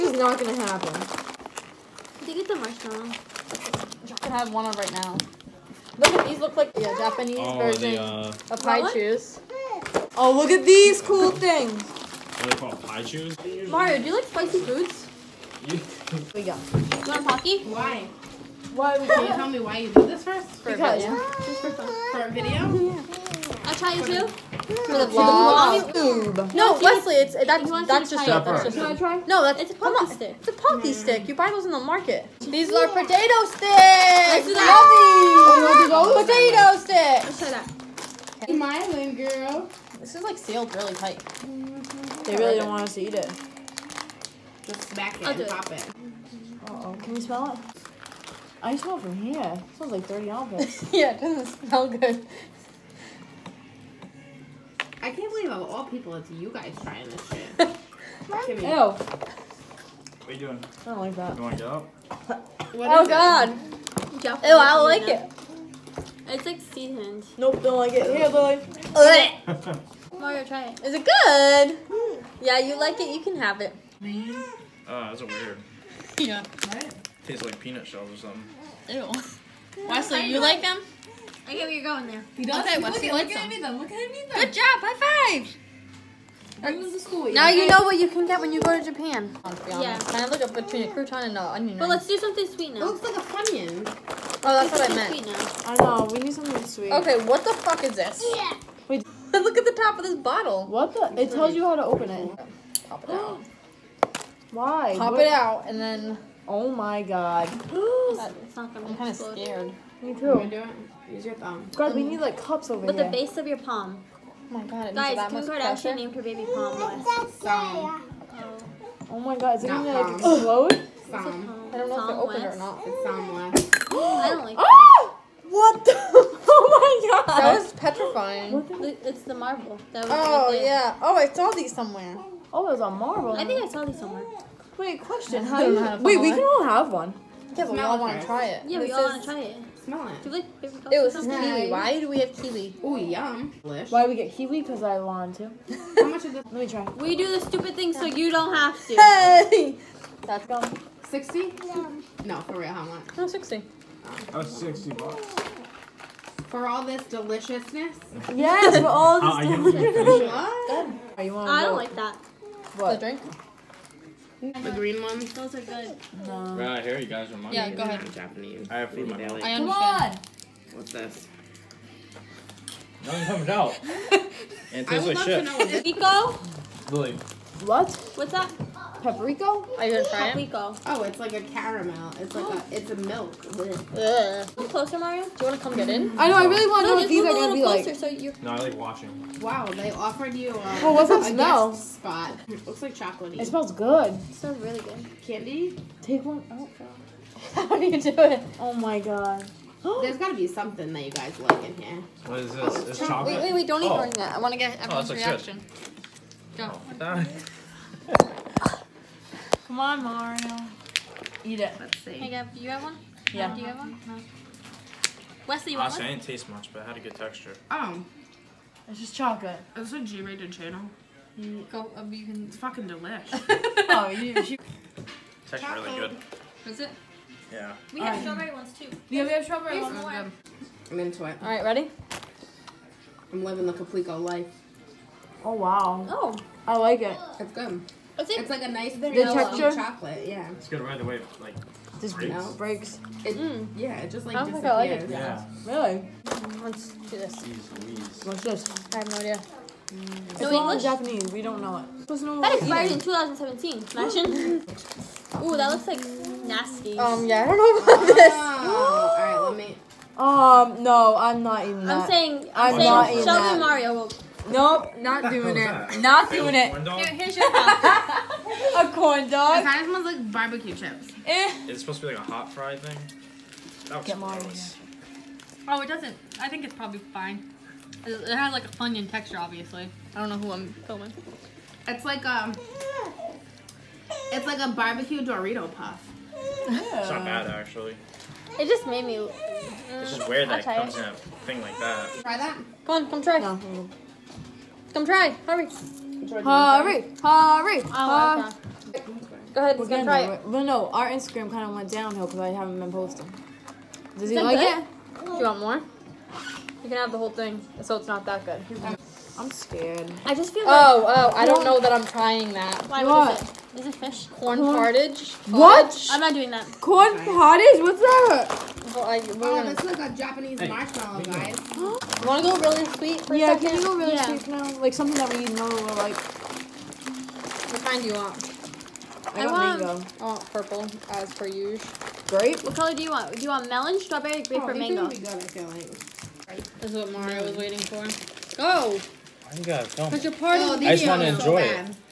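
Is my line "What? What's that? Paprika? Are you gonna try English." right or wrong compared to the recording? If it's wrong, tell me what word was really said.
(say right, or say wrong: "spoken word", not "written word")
wrong: "Paprika", not "English".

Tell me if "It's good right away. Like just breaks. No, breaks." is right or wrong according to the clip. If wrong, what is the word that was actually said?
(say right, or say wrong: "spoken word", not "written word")
right.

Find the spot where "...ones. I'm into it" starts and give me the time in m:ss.
3:49.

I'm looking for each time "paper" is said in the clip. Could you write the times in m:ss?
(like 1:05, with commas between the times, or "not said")
2:20.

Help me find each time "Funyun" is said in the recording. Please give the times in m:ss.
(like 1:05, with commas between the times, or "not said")
1:33, 4:38.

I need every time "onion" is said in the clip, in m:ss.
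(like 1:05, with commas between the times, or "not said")
1:31.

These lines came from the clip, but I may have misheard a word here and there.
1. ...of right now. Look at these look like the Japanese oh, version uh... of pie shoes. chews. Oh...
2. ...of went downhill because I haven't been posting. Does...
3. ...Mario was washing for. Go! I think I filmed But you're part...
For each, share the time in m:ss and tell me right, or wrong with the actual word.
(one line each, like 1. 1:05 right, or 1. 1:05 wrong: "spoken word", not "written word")
1. 0:04 right
2. 5:01 right
3. 5:37 wrong: "waiting", not "washing".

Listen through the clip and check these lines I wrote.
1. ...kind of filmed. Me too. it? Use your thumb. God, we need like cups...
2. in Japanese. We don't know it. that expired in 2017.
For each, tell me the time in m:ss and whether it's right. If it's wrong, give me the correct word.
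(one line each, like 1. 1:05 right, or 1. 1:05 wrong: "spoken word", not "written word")
1. 1:48 wrong: "scared", not "filmed"
2. 4:10 right.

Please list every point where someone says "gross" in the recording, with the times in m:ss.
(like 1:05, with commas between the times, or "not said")
4:34.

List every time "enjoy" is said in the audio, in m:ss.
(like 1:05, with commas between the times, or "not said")
5:41.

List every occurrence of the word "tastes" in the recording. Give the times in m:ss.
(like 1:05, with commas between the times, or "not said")
1:17, 2:54, 3:36.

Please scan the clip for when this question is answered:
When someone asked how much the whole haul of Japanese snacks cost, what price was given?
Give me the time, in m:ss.
2:34.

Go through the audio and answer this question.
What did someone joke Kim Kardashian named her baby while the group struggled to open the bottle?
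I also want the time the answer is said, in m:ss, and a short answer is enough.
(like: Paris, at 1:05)
Palm West, at 1:56.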